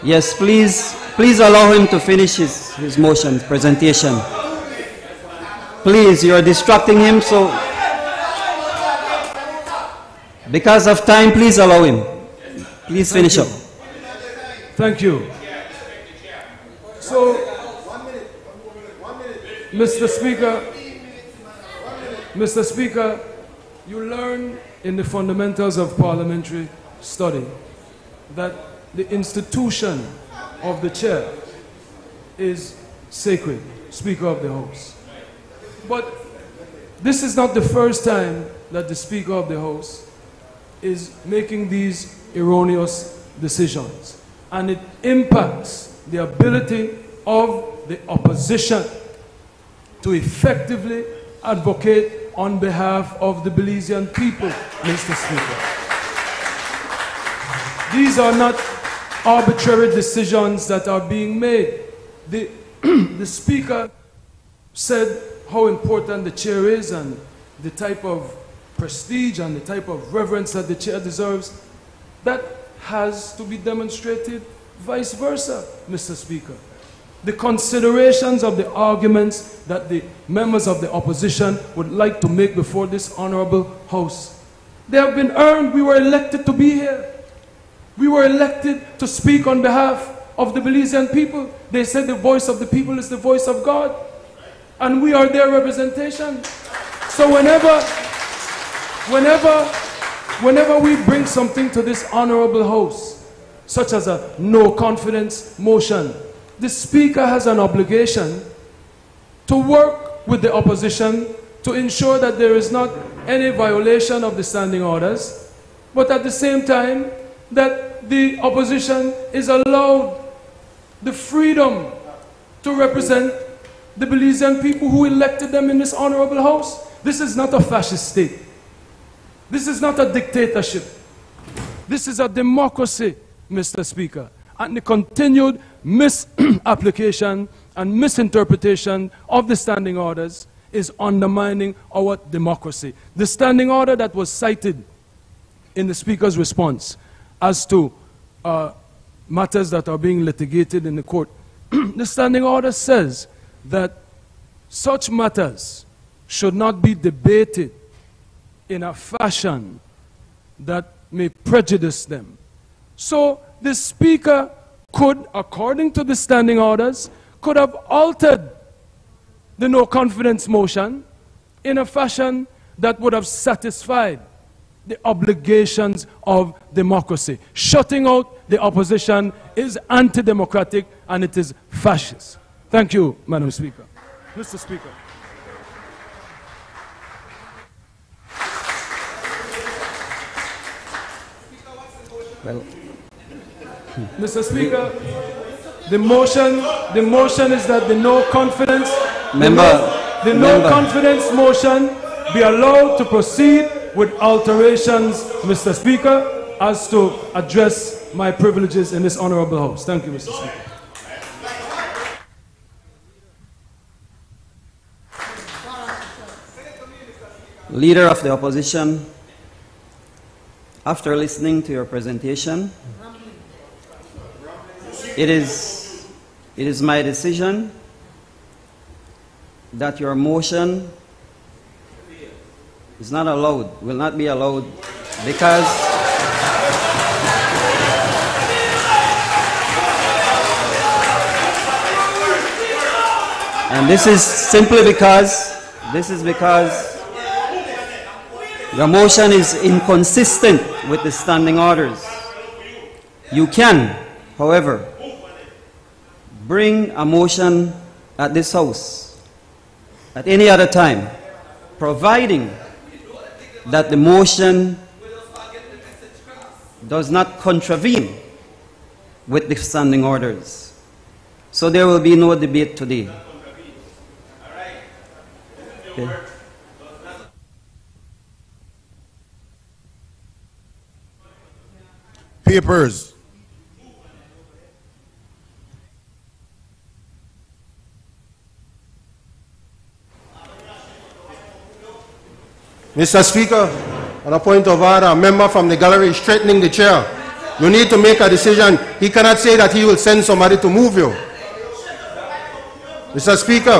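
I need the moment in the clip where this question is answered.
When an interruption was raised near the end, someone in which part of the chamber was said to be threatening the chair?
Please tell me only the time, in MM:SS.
04:55.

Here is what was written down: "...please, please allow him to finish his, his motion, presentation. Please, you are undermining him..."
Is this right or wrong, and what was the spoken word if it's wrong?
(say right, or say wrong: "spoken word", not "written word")
wrong: "distracting", not "undermining".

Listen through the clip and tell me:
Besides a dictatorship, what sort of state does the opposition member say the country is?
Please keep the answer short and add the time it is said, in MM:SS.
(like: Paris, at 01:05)
A fascist state, at 02:07.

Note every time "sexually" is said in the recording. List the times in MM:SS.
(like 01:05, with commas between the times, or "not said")
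not said.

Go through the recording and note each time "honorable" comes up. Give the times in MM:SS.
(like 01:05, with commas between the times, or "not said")
01:23, 01:42, 02:05, 03:29.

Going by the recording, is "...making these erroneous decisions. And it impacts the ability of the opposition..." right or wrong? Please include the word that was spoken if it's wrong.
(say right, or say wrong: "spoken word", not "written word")
right.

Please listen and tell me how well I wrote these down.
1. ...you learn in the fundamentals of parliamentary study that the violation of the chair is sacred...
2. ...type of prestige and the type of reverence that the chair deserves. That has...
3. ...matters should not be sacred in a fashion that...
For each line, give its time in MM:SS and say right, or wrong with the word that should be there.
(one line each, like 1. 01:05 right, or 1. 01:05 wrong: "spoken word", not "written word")
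1. 00:23 wrong: "institution", not "violation"
2. 01:07 right
3. 02:35 wrong: "debated", not "sacred".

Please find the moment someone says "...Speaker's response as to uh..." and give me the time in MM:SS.
02:25.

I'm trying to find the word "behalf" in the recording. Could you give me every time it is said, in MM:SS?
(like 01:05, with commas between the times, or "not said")
00:52, 01:29.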